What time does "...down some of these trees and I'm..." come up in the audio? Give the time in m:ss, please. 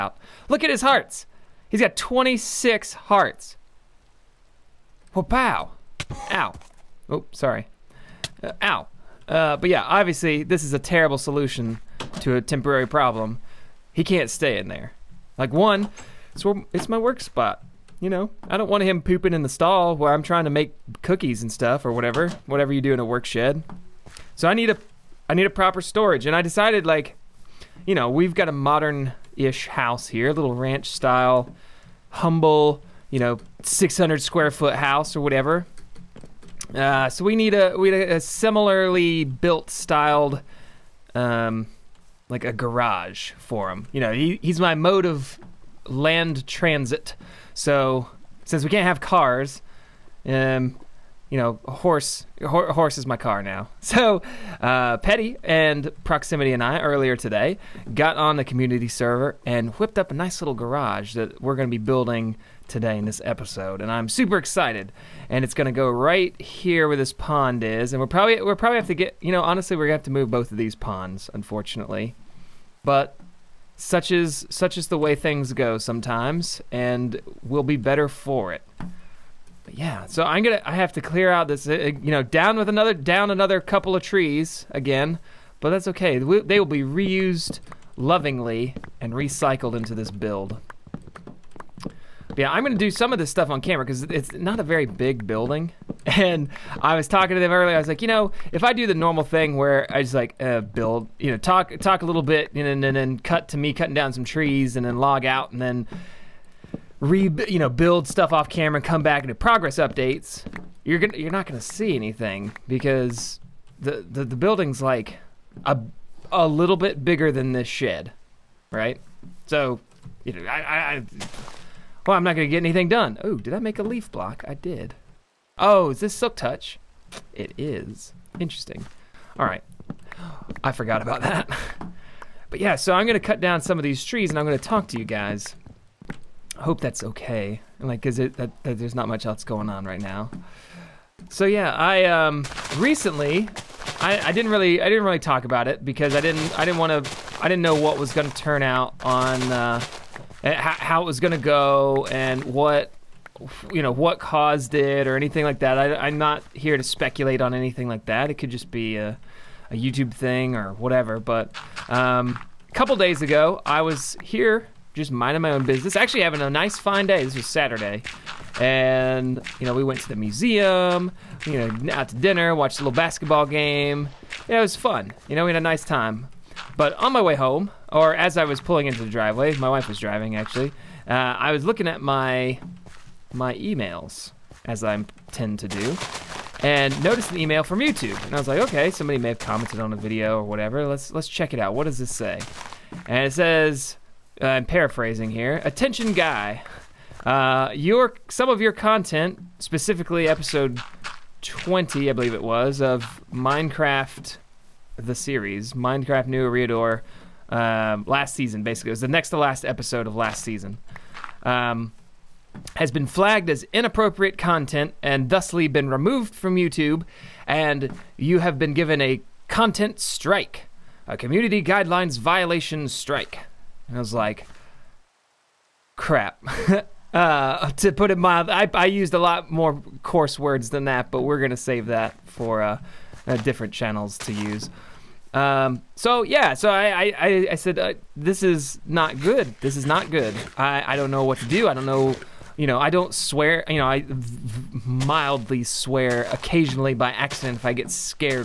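2:13.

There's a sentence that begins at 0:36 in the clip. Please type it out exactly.
Uh, so we need a we need a similarly built styled, um, like a garage for him.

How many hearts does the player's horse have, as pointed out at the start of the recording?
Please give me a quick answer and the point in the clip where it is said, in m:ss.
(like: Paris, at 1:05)
26, at 0:01.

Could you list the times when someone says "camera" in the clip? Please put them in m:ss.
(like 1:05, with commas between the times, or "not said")
1:33, 1:48.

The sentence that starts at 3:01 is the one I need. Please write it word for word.
Uh, I was looking at my my emails as I tend to do, and noticed an email from YouTube.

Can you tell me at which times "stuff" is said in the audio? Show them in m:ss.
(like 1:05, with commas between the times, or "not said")
0:21, 1:33, 1:48.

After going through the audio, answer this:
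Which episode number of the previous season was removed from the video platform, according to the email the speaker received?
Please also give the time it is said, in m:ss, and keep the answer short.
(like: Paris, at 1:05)
20, at 3:20.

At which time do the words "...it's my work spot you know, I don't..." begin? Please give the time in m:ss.
0:16.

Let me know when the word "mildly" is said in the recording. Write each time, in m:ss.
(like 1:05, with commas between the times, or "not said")
3:48, 4:04.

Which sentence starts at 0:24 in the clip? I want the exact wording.
So I need a, I need a proper storage.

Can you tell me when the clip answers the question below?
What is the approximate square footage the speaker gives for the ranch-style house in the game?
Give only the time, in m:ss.
0:33.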